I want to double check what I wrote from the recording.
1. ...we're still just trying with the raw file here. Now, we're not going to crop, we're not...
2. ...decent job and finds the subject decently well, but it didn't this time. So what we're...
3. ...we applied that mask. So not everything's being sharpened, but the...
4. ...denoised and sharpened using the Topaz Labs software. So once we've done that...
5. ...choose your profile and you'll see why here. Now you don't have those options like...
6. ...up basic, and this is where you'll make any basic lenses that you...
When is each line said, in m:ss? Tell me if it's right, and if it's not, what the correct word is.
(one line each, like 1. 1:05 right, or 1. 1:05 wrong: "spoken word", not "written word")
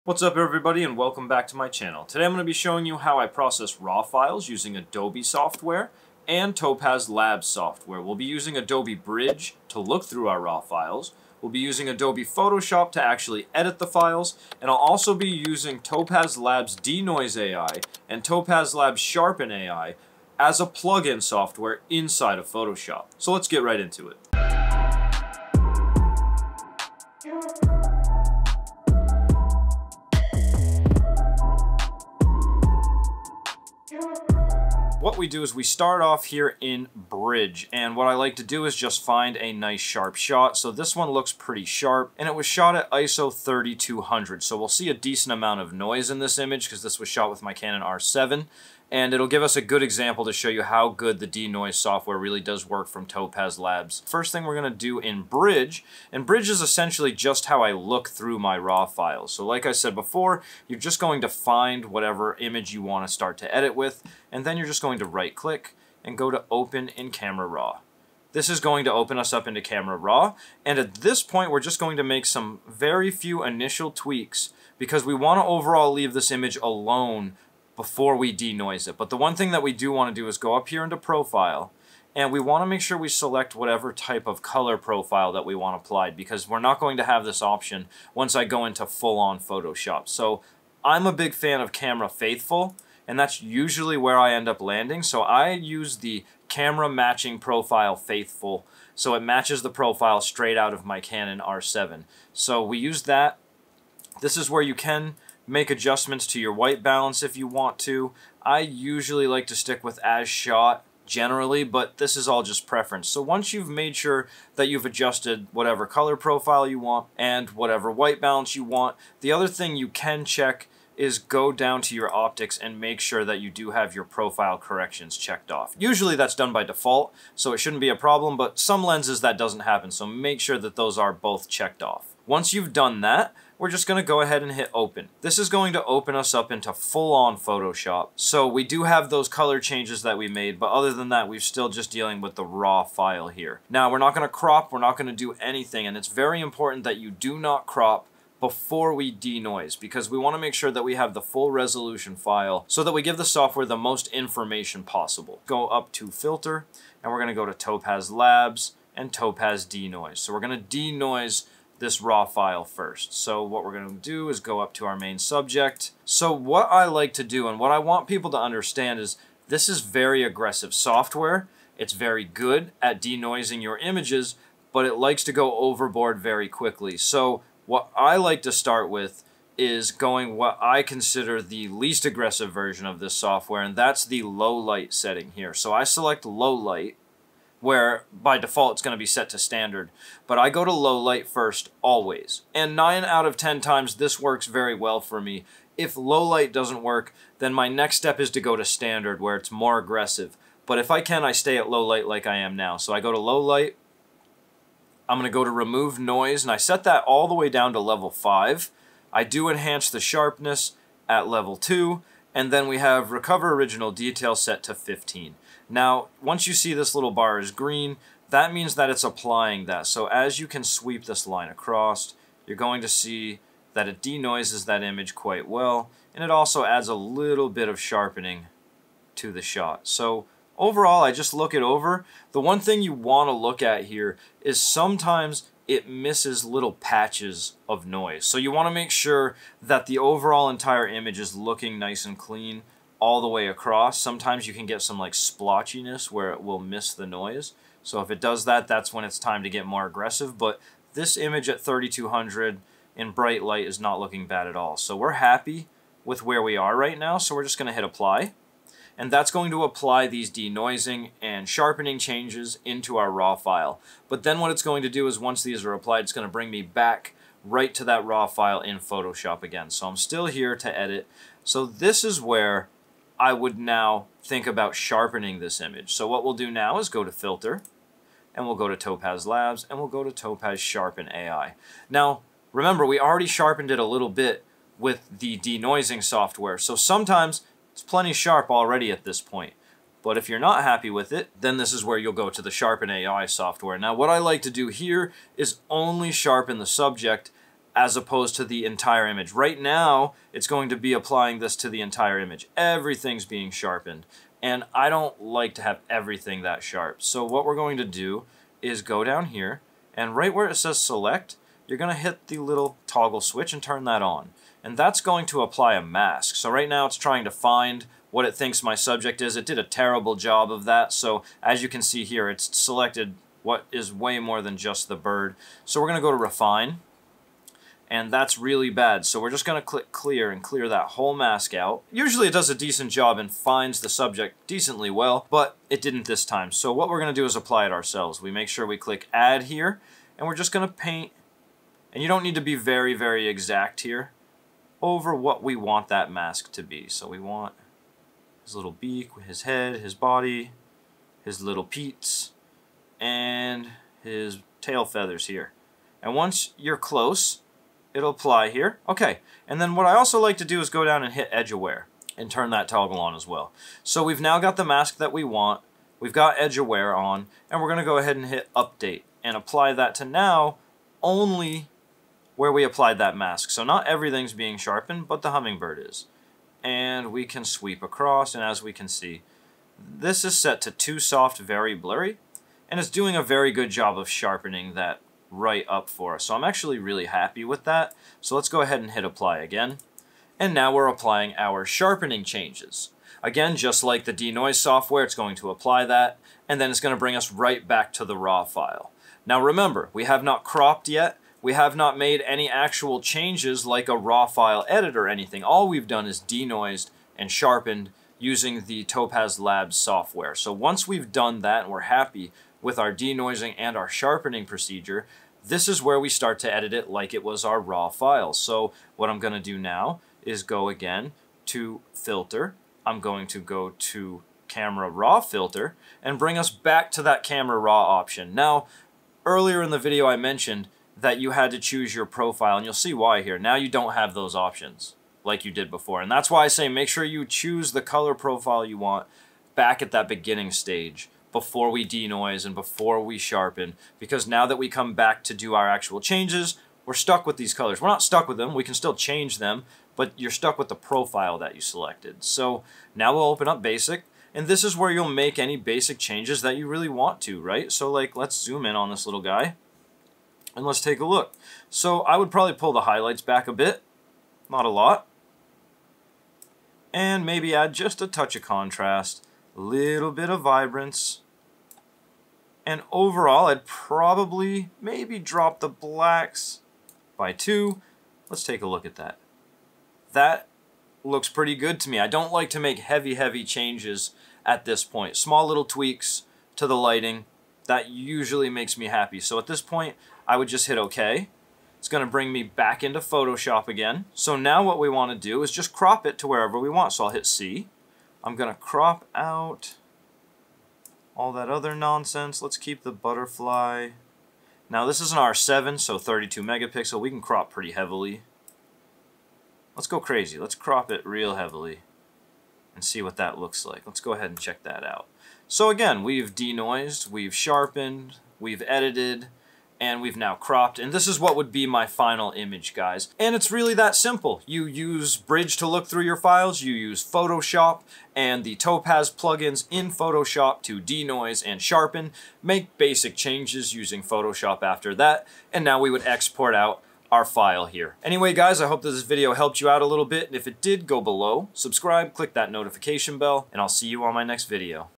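1. 2:21 wrong: "dealing", not "trying"
2. 5:32 right
3. 6:12 right
4. 6:46 right
5. 7:11 right
6. 7:33 wrong: "changes", not "lenses".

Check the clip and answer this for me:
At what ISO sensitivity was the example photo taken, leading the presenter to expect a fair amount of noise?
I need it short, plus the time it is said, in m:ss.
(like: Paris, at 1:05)
3200, at 0:42.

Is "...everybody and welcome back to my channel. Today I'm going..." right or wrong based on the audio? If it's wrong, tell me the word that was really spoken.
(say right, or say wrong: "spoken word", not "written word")
right.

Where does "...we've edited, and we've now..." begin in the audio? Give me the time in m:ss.
8:38.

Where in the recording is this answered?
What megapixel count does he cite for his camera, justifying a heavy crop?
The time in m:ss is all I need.
8:25.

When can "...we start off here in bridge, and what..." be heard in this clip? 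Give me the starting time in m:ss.
0:35.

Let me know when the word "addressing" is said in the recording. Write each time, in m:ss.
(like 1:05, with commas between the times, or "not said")
not said.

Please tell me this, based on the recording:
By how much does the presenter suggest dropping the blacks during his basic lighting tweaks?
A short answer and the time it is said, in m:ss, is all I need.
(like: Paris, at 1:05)
2, at 7:57.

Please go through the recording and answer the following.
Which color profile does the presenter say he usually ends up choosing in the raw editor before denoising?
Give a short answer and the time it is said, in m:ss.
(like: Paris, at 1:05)
Camera Faithful, at 1:31.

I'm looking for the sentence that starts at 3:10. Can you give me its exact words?
But I go to low light first always.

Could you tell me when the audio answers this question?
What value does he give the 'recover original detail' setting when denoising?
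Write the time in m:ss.
3:34.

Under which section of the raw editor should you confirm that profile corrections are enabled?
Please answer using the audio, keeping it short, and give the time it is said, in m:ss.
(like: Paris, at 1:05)
optics, at 2:02.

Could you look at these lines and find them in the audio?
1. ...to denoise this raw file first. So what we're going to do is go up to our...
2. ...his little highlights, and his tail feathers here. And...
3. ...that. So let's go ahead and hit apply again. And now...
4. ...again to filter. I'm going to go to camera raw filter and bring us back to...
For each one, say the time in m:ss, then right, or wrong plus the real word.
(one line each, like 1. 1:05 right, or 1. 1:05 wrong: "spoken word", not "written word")
1. 2:40 right
2. 5:51 wrong: "peats", not "highlights"
3. 6:27 right
4. 7:00 right.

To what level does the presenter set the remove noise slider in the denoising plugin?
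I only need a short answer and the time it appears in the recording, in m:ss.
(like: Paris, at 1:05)
5, at 3:27.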